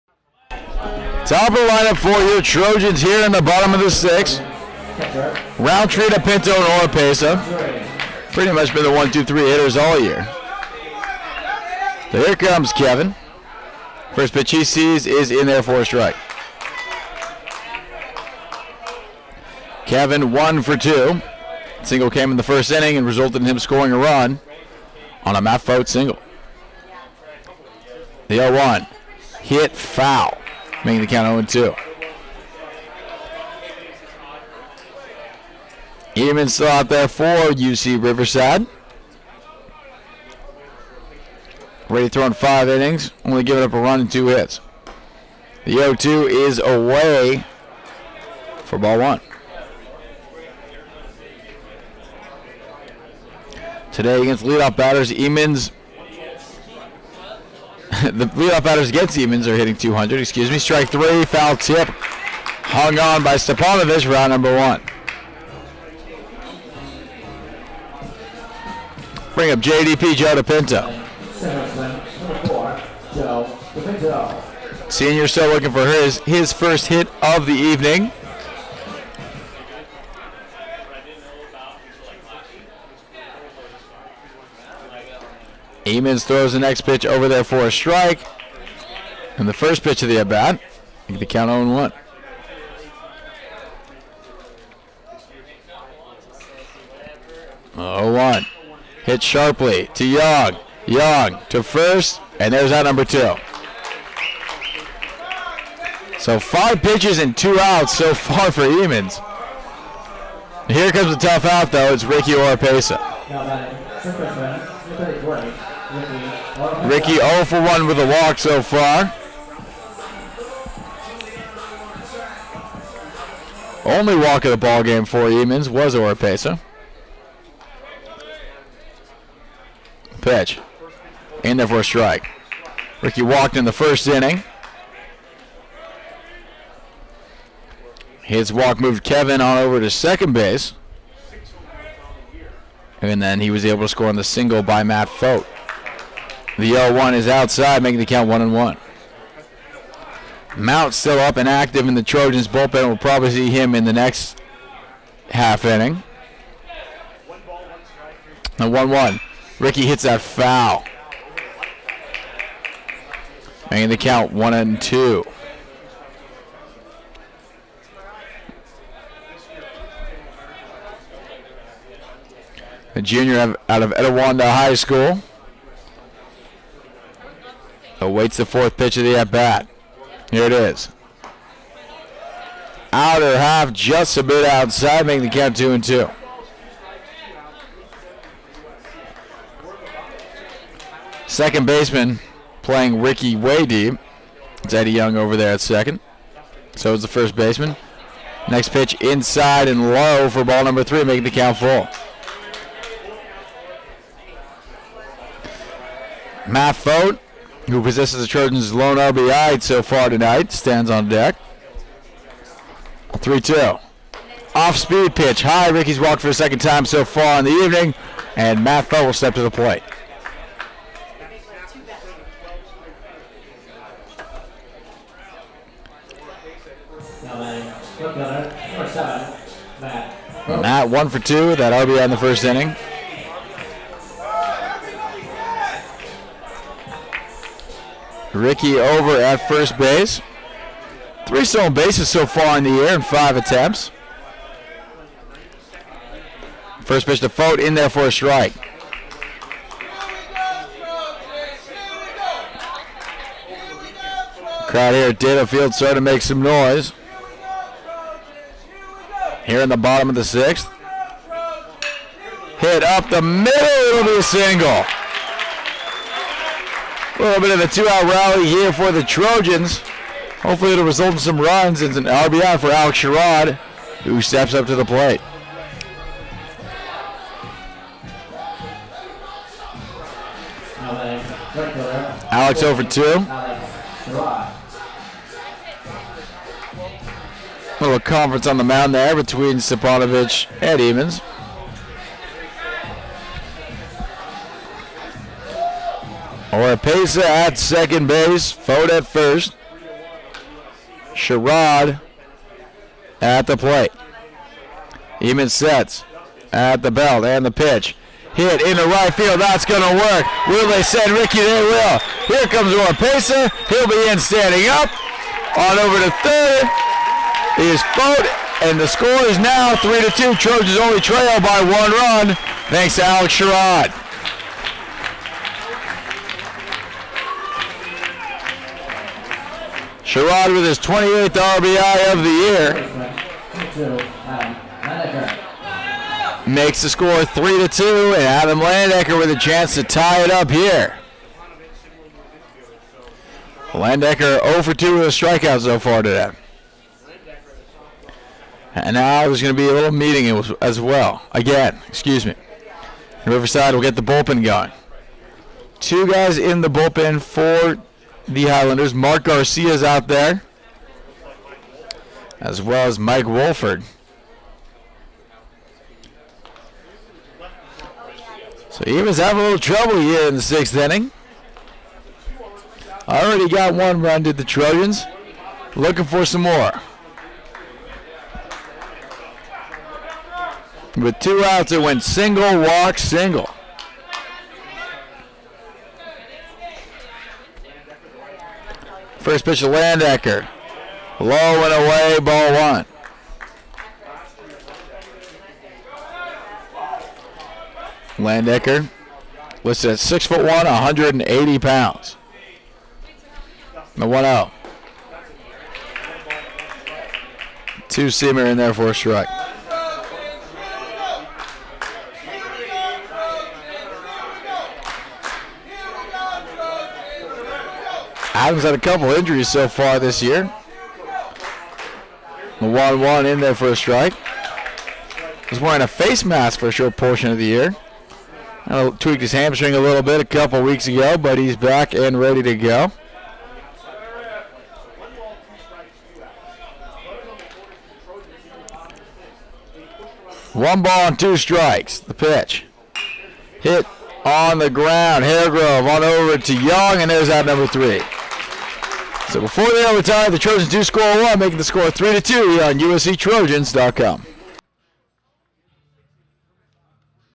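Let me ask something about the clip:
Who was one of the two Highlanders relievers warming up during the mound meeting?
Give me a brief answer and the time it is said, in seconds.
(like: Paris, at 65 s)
Mark Garcia, at 358 s.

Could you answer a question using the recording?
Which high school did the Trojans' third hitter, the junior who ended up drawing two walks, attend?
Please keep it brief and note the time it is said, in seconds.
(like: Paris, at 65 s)
Etiwanda High School, at 173 s.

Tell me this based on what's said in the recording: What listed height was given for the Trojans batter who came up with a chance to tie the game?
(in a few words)
6 foot 1.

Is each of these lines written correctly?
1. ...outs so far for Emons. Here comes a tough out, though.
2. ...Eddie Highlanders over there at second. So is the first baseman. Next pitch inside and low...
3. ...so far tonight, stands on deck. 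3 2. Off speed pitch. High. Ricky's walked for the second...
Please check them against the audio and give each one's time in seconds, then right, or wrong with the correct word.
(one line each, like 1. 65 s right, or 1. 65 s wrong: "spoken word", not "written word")
1. 107 s right
2. 194 s wrong: "Young", not "Highlanders"
3. 209 s right.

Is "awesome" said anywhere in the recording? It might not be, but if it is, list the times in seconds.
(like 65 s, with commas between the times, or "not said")
not said.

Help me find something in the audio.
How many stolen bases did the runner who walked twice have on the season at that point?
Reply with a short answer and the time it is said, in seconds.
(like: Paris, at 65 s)
3, at 241 s.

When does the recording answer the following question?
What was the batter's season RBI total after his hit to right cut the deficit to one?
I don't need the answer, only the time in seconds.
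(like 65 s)
330 s.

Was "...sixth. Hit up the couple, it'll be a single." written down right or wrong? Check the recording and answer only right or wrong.
wrong.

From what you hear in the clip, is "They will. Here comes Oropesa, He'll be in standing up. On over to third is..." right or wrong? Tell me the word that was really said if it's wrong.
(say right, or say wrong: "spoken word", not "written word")
right.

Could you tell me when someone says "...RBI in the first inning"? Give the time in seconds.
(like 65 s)
231 s.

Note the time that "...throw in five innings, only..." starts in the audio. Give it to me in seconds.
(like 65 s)
42 s.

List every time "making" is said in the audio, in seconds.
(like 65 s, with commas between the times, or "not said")
30 s, 147 s, 163 s, 185 s, 201 s, 451 s.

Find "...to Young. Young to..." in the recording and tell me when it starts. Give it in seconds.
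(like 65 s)
99 s.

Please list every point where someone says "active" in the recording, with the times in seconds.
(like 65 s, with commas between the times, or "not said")
151 s.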